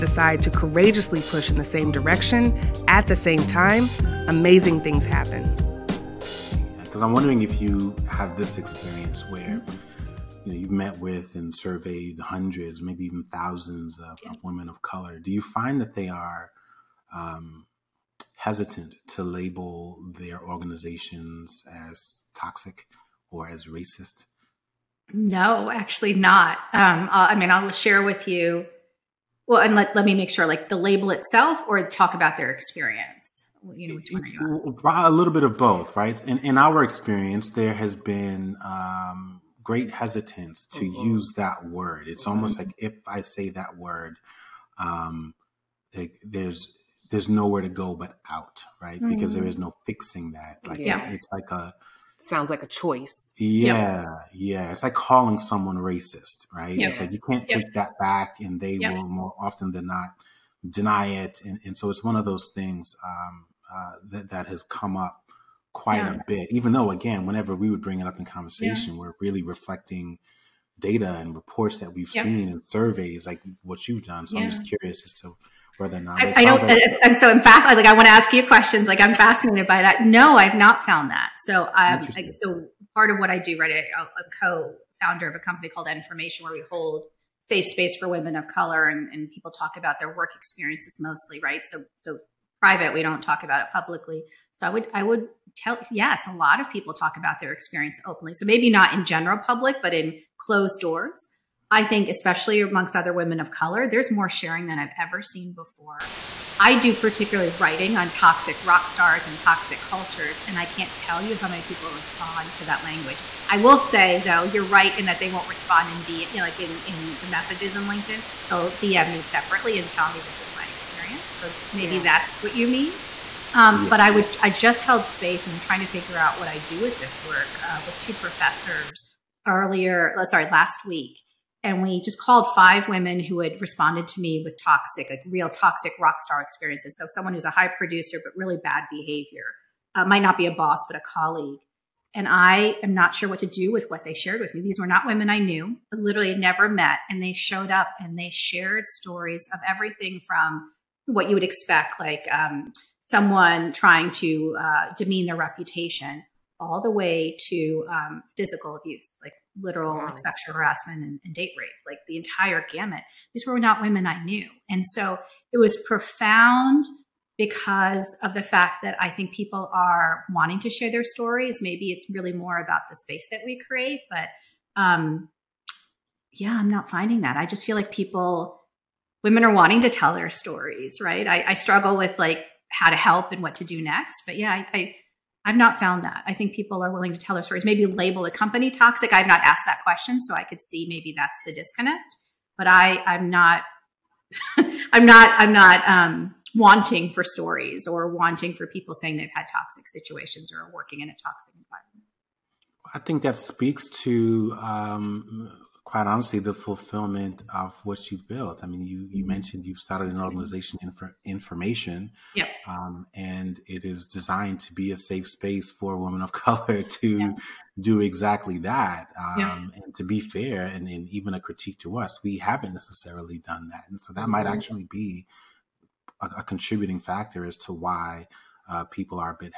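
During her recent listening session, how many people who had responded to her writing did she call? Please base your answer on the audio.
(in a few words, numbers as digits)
5.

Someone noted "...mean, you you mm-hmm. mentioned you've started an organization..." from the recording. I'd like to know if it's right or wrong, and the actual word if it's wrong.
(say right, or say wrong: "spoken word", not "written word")
right.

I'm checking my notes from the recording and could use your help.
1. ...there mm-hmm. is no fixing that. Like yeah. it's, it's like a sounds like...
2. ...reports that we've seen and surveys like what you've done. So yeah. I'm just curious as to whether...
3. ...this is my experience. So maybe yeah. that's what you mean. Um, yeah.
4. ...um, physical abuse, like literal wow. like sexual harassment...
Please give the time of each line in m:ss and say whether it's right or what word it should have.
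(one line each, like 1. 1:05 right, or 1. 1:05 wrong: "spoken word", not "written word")
1. 0:49 right
2. 1:11 right
3. 2:00 right
4. 2:37 right.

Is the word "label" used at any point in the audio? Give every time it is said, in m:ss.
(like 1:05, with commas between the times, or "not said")
0:19, 0:30, 3:07.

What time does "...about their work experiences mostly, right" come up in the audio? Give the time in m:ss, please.
1:29.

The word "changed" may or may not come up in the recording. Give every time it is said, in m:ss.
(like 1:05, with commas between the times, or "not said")
not said.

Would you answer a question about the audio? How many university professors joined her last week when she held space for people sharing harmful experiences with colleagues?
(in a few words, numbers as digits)
2.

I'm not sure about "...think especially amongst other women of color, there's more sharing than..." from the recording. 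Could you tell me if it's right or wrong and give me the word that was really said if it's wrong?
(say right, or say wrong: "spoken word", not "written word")
right.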